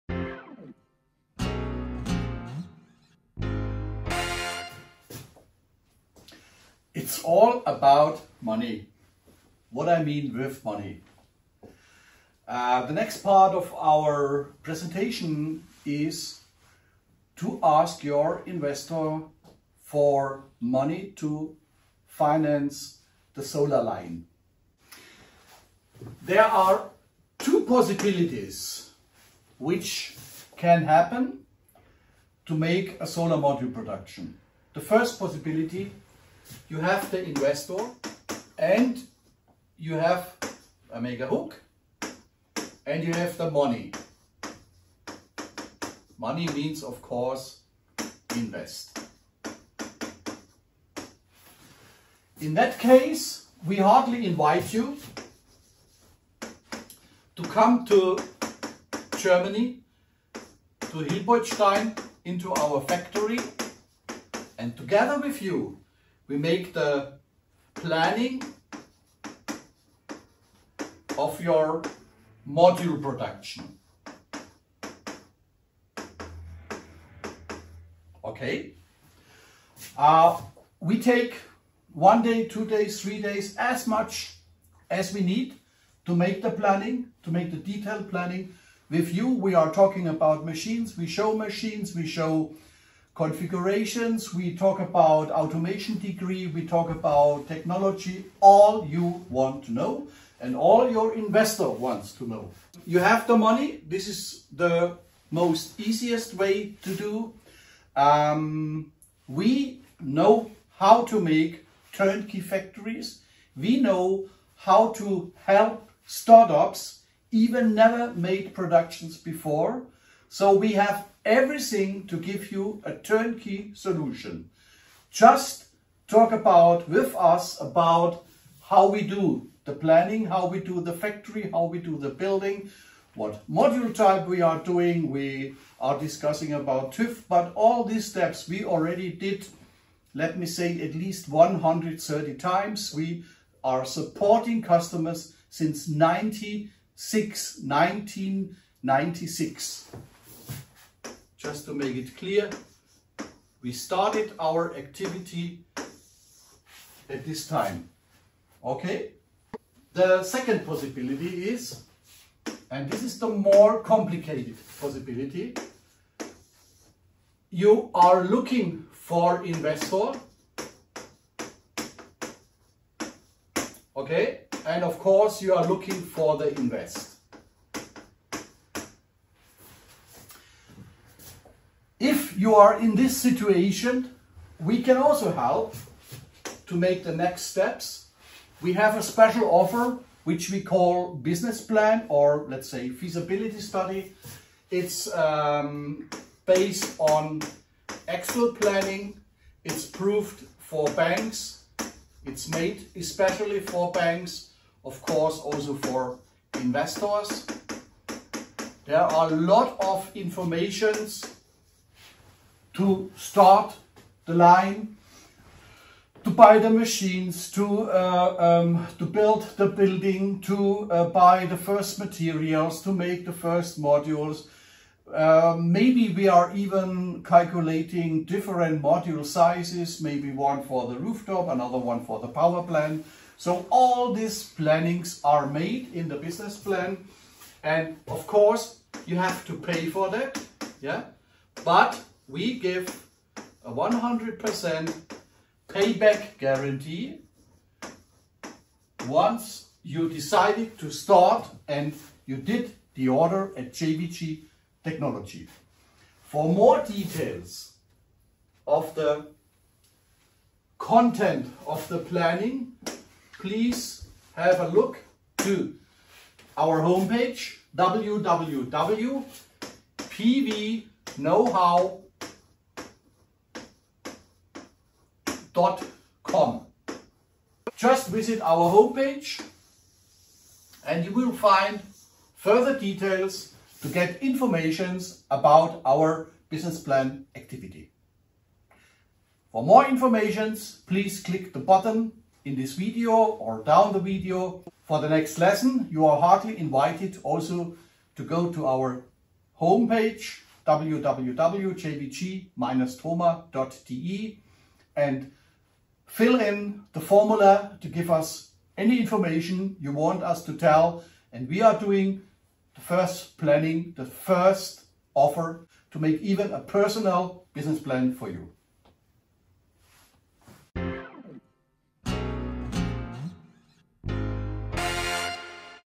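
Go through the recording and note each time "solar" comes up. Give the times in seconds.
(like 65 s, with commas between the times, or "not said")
23 s, 33 s.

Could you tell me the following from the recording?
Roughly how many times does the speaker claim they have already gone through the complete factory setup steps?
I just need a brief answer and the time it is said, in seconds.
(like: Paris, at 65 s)
130, at 141 s.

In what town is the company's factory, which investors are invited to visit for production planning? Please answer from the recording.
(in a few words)
Hilpoltstein.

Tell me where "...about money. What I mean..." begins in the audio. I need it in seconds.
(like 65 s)
7 s.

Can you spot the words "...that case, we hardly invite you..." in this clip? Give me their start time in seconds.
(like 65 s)
52 s.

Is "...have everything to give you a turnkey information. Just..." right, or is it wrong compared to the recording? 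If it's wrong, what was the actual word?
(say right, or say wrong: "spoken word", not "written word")
wrong: "solution", not "information".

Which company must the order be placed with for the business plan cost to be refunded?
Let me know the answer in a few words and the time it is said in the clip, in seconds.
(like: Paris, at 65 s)
JvG Technology, at 253 s.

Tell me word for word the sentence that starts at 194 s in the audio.
It's um, based on actual planning.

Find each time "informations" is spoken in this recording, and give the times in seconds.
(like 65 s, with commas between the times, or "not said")
210 s, 284 s, 289 s, 308 s.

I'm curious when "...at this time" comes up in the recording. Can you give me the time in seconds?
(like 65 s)
157 s.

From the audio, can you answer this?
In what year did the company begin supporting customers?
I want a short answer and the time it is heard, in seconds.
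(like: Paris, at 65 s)
1996, at 147 s.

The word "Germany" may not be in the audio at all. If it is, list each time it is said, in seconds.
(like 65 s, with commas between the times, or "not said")
59 s.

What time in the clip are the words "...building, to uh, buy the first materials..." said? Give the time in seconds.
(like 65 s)
219 s.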